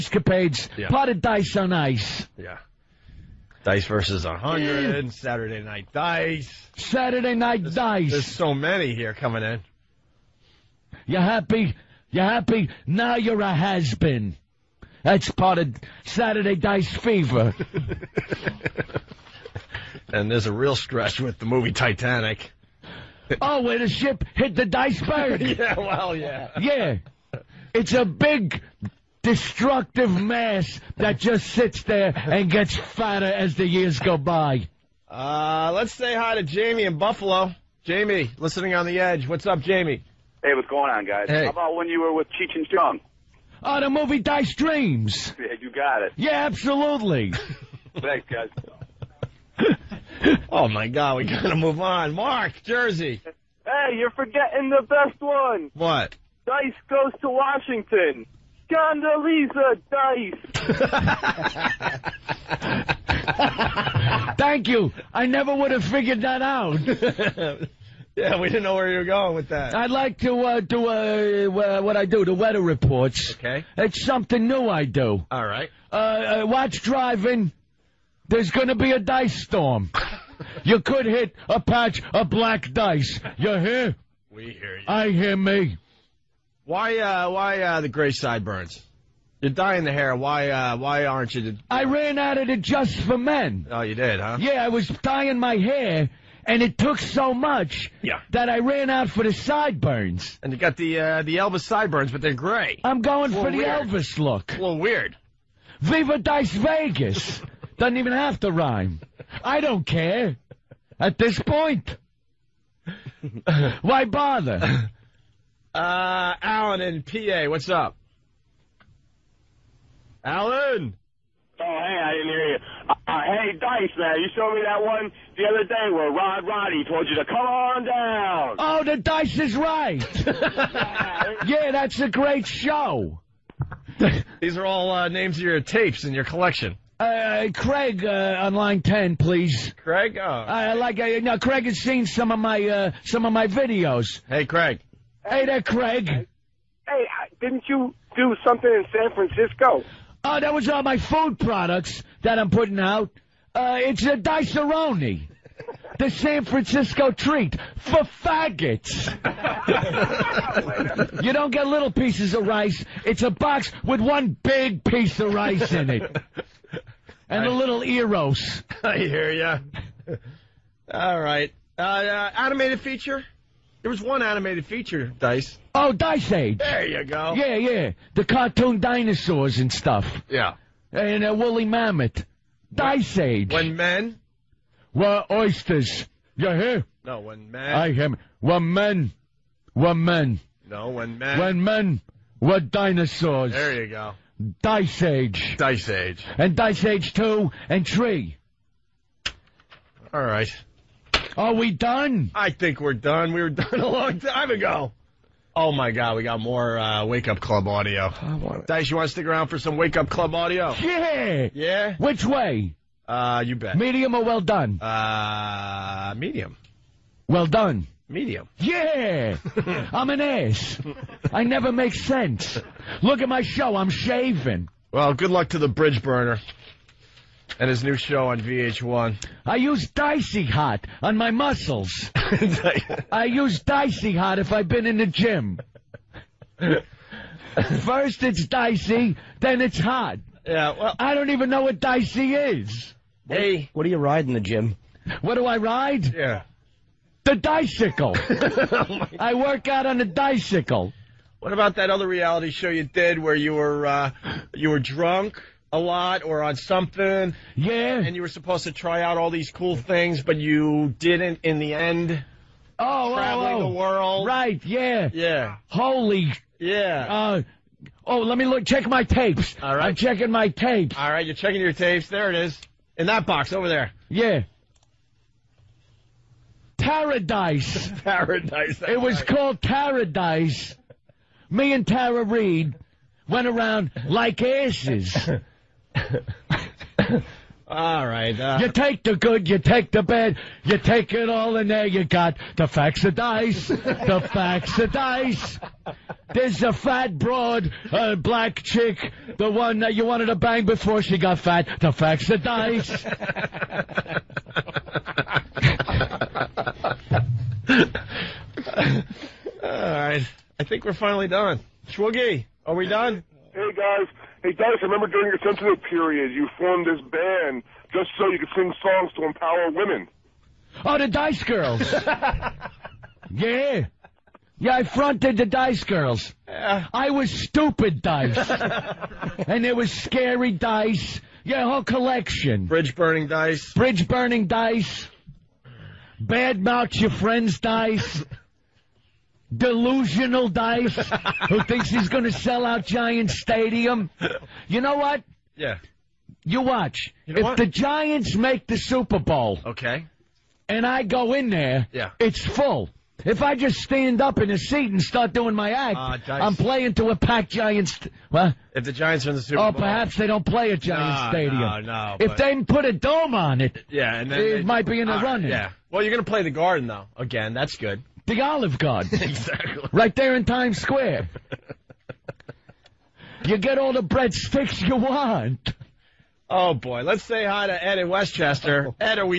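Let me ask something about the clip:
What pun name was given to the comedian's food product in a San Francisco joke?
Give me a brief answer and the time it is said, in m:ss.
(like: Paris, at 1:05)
Diceroni, at 2:34.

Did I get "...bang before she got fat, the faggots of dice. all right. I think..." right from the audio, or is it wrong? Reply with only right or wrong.
wrong.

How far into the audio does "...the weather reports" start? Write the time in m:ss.
1:12.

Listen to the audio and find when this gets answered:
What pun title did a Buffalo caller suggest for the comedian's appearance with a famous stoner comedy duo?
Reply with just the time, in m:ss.
0:44.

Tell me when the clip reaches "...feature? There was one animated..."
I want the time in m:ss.
2:52.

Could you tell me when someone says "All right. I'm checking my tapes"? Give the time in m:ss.
4:29.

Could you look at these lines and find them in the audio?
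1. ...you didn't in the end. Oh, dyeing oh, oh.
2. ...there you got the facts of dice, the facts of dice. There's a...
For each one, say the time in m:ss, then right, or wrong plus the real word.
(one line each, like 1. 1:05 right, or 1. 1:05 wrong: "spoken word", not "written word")
1. 4:20 wrong: "traveling", not "dyeing"
2. 4:51 right.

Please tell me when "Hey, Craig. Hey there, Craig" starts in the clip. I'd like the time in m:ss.
2:24.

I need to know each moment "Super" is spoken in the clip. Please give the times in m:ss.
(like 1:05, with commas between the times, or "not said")
5:48, 5:59.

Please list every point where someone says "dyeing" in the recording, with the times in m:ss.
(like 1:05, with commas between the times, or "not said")
1:29, 1:34.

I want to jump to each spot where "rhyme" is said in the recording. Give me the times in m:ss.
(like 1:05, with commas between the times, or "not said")
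1:48.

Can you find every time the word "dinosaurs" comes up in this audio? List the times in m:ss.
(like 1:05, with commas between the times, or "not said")
2:58, 3:12.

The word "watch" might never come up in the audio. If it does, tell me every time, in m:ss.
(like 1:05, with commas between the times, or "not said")
1:16, 5:46.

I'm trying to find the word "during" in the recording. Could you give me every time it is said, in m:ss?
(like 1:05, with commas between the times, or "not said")
5:15.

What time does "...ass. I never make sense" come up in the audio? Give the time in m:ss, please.
3:40.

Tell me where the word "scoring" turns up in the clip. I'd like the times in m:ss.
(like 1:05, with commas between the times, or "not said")
not said.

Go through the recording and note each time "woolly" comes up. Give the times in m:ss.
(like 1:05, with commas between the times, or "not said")
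3:01.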